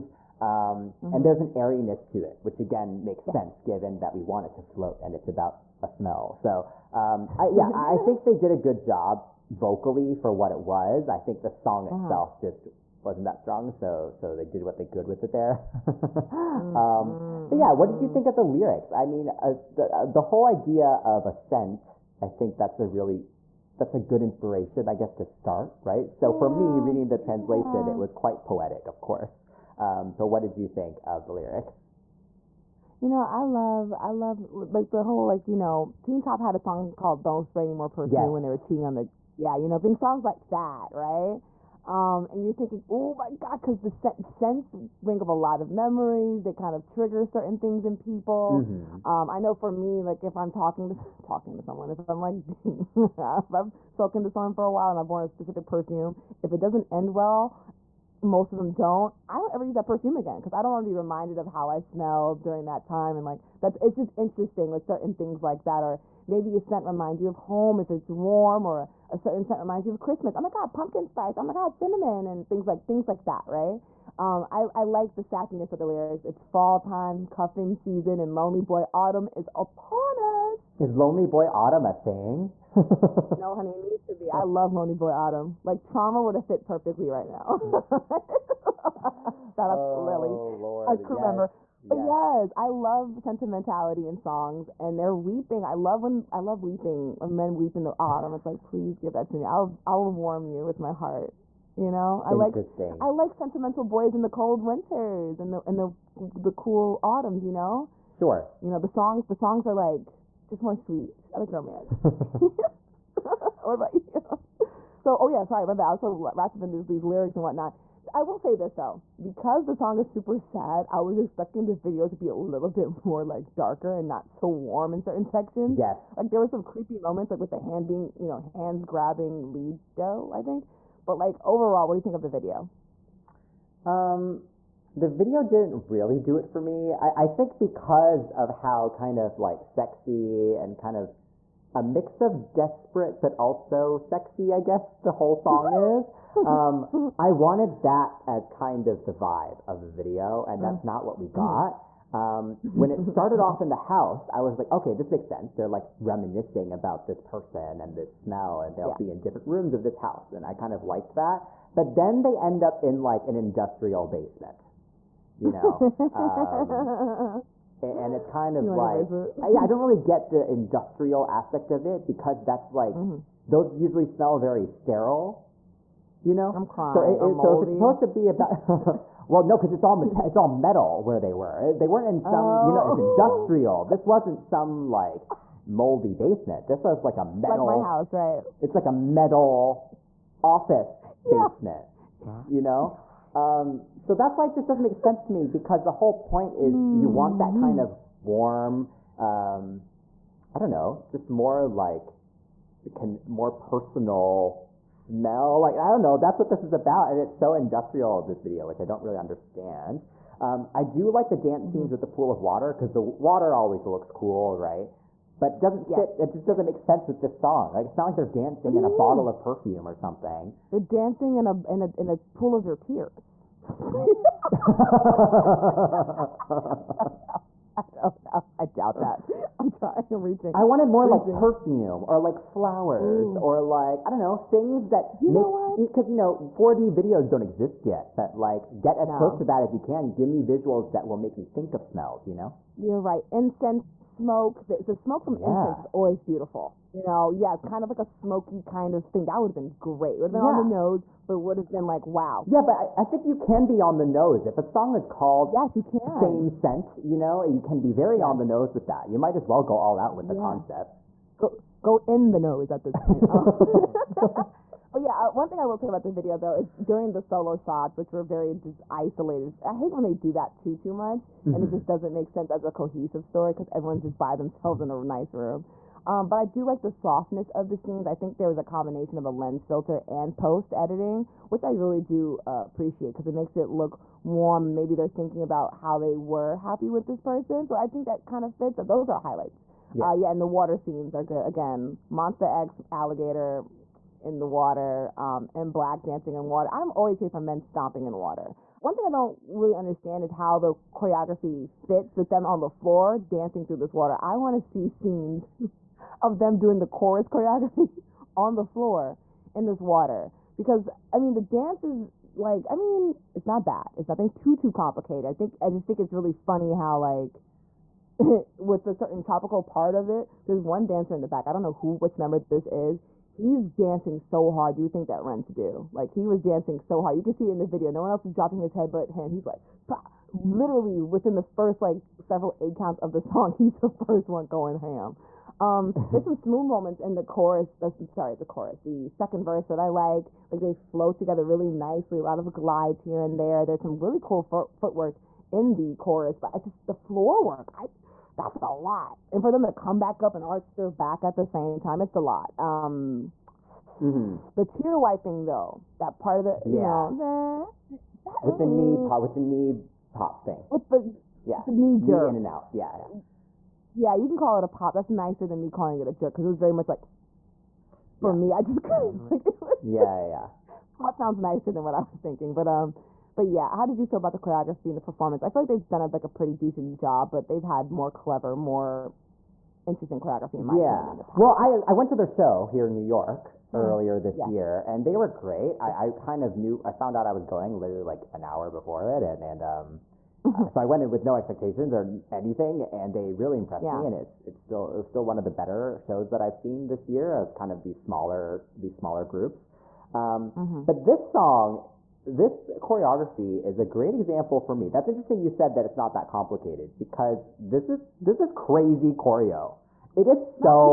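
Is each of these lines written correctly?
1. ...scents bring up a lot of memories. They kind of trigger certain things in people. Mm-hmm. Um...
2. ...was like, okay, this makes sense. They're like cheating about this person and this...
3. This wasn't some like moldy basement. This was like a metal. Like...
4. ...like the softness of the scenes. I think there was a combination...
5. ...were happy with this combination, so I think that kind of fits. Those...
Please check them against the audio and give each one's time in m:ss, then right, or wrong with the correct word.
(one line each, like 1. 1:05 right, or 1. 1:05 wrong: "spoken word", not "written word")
1. 0:44 right
2. 2:34 wrong: "reminiscing", not "cheating"
3. 3:03 right
4. 4:36 right
5. 4:46 wrong: "person", not "combination".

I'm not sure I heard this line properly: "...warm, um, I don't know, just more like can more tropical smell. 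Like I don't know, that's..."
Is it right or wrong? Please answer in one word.
wrong.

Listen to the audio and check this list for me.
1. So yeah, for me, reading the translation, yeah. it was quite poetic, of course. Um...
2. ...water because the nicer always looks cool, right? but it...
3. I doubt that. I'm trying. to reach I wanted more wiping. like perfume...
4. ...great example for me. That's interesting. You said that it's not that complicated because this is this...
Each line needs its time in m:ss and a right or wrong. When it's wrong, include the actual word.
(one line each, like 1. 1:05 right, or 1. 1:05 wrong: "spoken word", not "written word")
1. 0:26 right
2. 3:32 wrong: "water", not "nicer"
3. 3:48 wrong: "reaching", not "wiping"
4. 6:43 right.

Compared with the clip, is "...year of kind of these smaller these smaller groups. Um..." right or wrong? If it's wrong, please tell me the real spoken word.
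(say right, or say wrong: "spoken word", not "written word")
right.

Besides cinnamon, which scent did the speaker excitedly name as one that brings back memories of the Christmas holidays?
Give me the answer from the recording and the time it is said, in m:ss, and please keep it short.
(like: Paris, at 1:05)
pumpkin spice, at 1:10.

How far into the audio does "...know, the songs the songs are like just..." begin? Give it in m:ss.
1:48.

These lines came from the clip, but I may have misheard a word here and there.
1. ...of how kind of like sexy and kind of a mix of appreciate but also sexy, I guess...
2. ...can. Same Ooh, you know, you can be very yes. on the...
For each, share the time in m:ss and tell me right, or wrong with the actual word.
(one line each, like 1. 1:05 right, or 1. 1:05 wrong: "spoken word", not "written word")
1. 2:18 wrong: "desperate", not "appreciate"
2. 4:15 wrong: "Scent", not "Ooh".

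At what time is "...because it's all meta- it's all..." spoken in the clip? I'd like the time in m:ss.
2:59.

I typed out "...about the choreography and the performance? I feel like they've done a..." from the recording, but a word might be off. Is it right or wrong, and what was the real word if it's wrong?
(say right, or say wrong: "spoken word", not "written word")
right.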